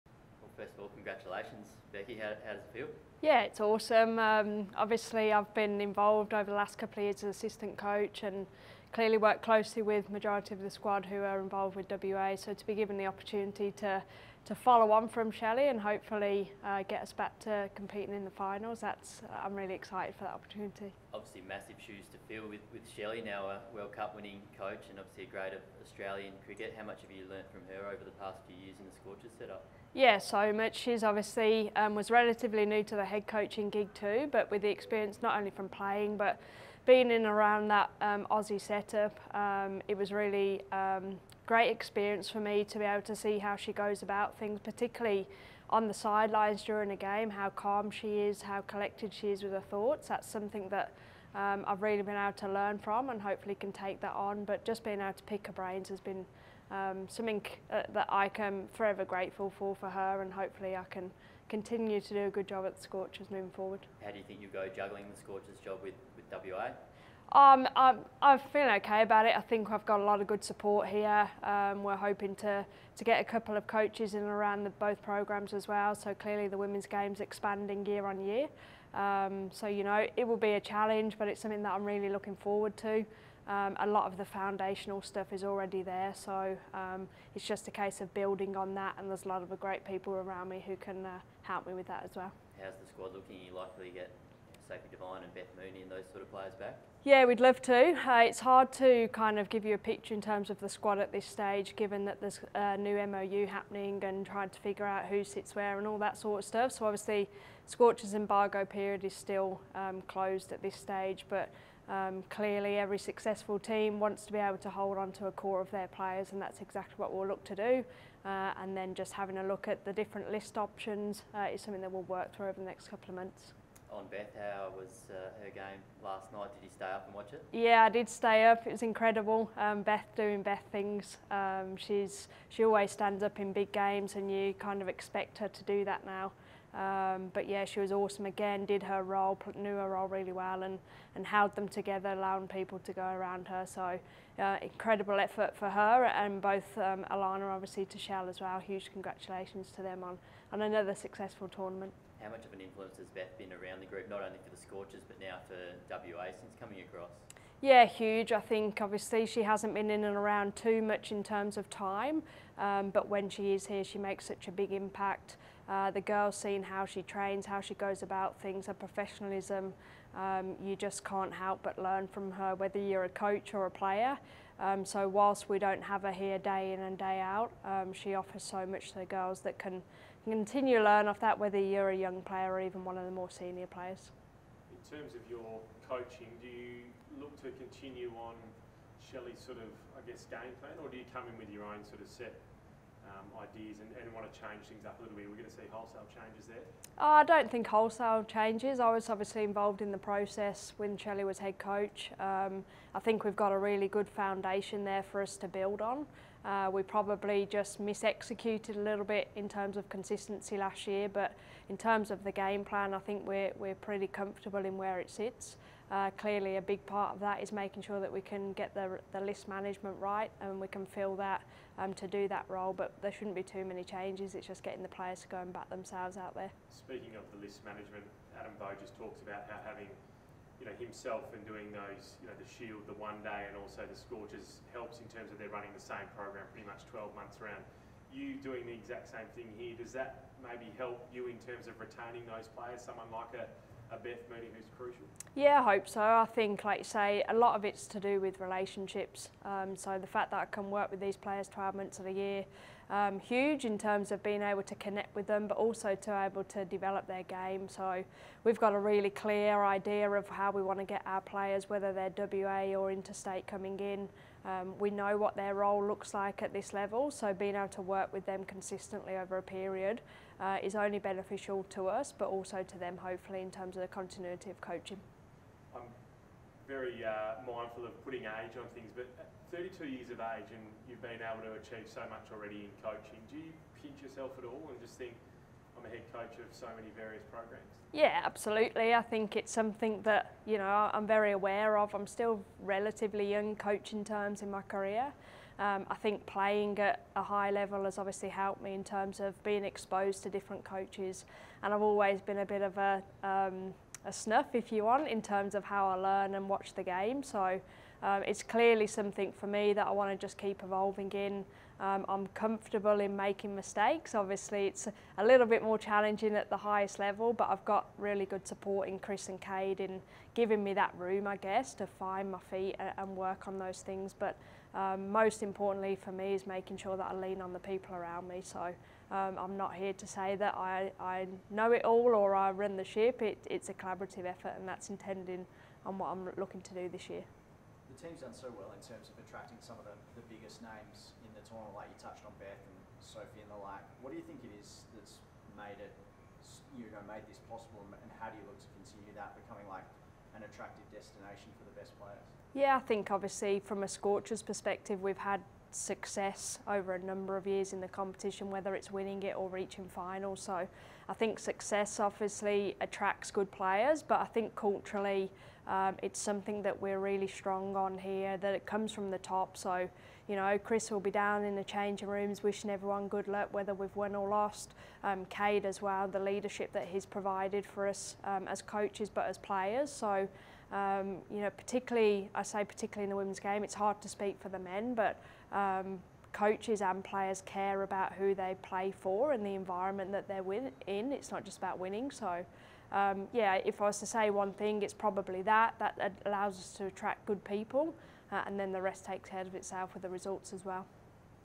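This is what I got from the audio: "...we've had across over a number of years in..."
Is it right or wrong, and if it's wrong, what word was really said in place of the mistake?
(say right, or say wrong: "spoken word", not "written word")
wrong: "success", not "across".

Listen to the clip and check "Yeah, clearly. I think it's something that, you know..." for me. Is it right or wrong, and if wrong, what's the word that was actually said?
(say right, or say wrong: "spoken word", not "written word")
wrong: "absolutely", not "clearly".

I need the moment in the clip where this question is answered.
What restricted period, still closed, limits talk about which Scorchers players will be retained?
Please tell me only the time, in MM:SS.
01:48.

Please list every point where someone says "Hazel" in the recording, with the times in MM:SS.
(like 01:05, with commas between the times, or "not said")
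not said.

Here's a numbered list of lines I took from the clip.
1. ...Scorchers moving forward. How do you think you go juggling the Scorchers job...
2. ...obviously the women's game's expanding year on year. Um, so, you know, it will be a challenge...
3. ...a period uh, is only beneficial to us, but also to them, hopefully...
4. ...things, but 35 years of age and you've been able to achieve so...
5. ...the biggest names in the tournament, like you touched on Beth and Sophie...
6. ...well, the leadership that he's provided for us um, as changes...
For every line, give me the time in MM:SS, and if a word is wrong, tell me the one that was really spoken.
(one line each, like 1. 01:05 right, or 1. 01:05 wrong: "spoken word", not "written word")
1. 01:02 right
2. 01:16 wrong: "clearly", not "obviously"
3. 04:29 right
4. 04:38 wrong: "32", not "35"
5. 05:40 right
6. 06:15 wrong: "coaches", not "changes".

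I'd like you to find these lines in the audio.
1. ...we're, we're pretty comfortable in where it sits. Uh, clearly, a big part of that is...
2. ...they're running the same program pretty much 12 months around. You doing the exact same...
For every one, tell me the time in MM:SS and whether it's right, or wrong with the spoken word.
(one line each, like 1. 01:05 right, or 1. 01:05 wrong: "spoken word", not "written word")
1. 03:33 right
2. 03:55 right.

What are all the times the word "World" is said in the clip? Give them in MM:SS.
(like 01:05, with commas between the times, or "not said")
00:23.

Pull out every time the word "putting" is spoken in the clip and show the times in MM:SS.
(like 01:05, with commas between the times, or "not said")
04:38.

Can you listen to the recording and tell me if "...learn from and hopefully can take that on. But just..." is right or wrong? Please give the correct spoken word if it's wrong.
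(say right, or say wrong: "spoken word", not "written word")
right.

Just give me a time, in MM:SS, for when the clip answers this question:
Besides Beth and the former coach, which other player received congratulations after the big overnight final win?
02:27.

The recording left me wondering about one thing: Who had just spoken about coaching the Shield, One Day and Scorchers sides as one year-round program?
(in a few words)
Adam Voges.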